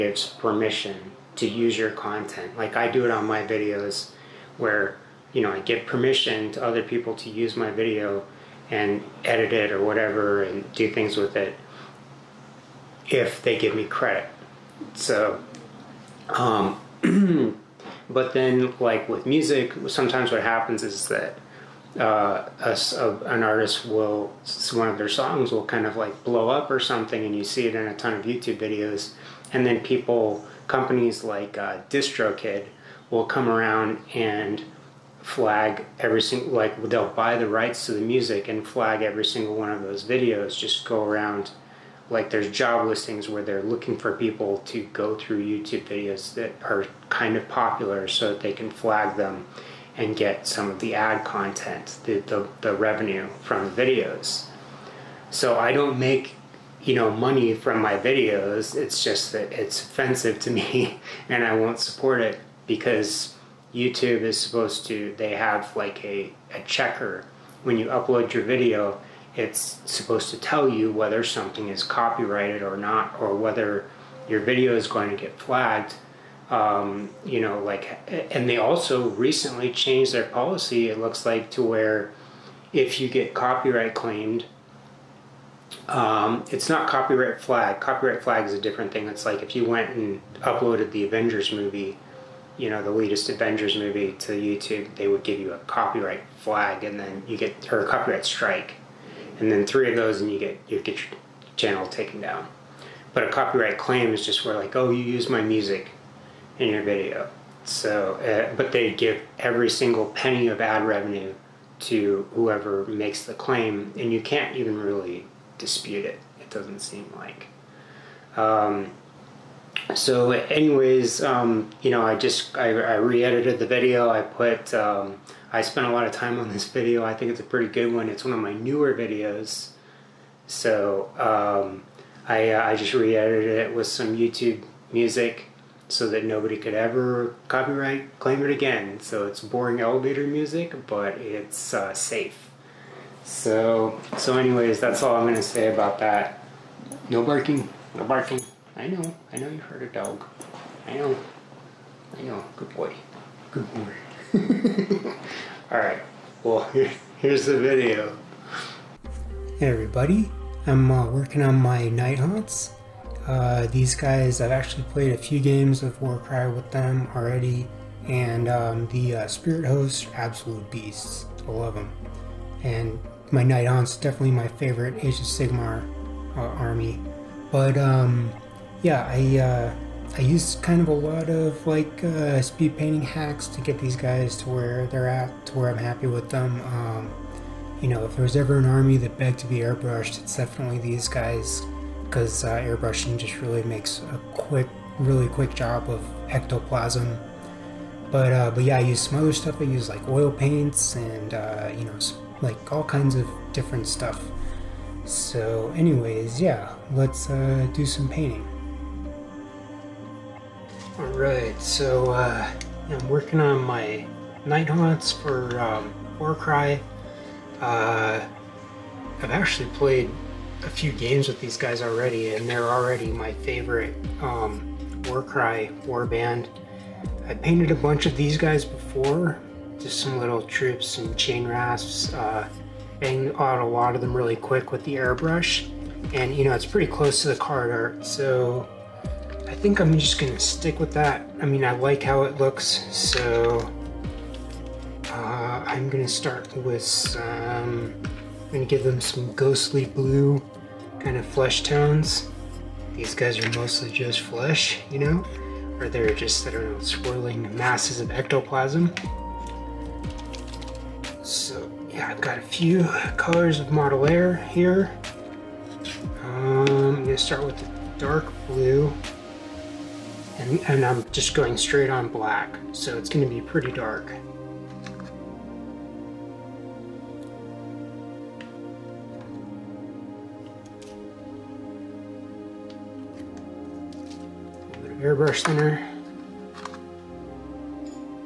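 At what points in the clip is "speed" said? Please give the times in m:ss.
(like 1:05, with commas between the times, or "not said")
3:02.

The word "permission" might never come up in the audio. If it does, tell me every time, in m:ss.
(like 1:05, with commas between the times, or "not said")
0:00, 0:05.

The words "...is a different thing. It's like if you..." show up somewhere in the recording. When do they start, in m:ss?
1:28.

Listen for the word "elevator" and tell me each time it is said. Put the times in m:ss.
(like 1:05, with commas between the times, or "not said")
2:19.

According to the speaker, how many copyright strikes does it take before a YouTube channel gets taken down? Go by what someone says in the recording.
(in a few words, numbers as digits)
3.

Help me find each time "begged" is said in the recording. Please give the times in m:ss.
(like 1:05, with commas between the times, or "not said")
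3:09.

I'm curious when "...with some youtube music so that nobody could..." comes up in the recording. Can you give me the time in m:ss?
2:13.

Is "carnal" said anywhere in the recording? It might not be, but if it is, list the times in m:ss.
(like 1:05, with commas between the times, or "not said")
not said.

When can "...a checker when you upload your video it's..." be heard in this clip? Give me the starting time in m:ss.
1:06.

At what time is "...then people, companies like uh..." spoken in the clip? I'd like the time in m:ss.
0:29.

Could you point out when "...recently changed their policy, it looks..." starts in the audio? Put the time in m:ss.
1:19.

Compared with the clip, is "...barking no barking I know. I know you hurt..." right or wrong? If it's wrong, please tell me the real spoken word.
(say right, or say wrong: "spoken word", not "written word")
right.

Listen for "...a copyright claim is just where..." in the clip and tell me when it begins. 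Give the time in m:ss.
1:43.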